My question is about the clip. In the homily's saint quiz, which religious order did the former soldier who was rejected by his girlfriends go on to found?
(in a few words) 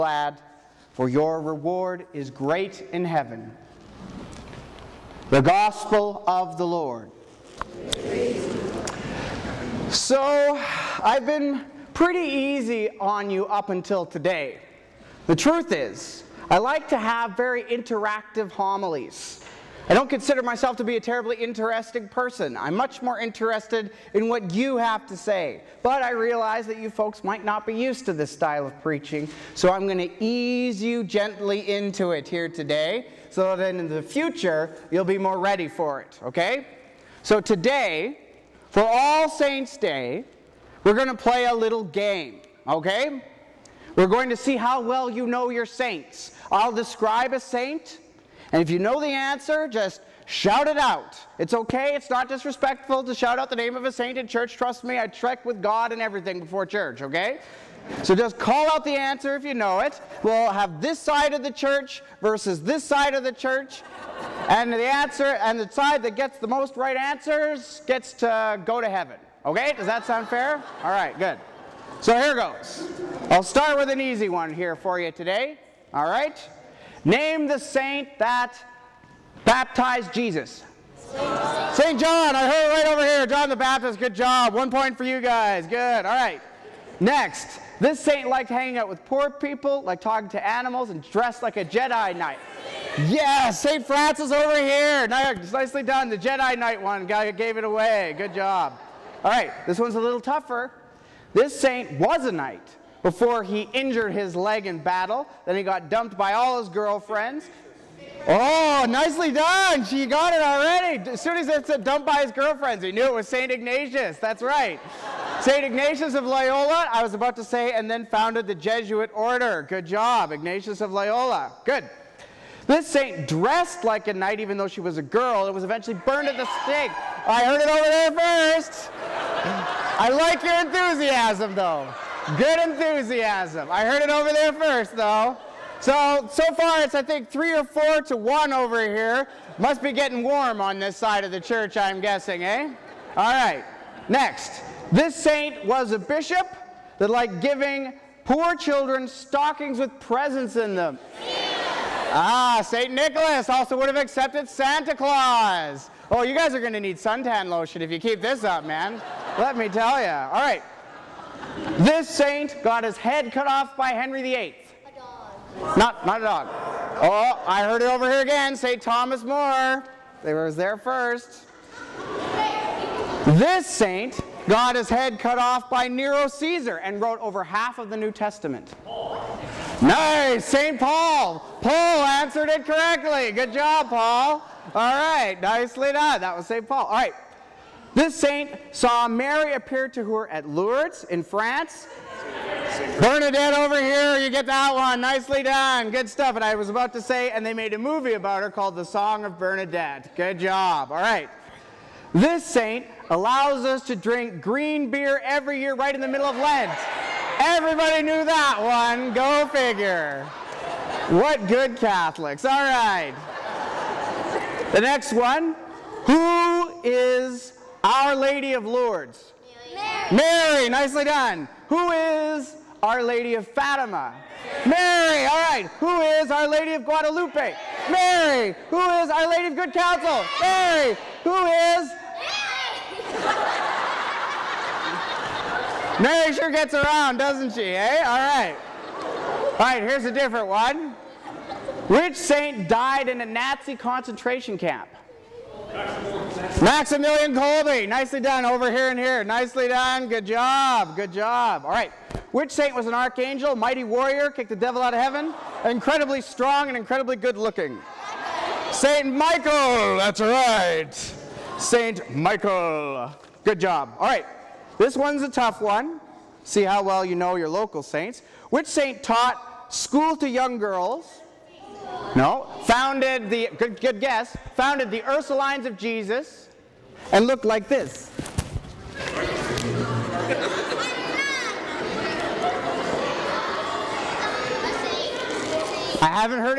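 The Jesuit order.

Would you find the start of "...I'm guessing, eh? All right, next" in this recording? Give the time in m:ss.
2:21.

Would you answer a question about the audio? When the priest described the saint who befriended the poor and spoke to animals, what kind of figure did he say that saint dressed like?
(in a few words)
A Jedi Knight.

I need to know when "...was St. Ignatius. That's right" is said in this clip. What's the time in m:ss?
1:53.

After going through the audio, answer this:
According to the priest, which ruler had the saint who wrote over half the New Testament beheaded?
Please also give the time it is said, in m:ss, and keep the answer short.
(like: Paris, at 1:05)
Nero Caesar, at 2:55.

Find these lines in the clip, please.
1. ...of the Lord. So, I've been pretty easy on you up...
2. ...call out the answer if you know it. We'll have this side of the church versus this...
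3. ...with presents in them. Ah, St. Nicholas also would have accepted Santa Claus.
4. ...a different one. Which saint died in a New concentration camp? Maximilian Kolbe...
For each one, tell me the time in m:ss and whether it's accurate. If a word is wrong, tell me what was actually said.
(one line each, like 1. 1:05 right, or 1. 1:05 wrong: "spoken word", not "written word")
1. 0:06 right
2. 0:58 right
3. 2:29 right
4. 4:00 wrong: "Nazi", not "New".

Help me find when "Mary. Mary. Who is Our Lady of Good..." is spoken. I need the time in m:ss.
3:47.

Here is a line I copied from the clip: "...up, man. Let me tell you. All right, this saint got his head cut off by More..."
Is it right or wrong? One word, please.
wrong.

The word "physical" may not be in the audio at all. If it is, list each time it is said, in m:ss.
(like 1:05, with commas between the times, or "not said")
not said.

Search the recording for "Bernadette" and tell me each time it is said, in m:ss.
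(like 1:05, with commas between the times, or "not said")
3:13, 3:19.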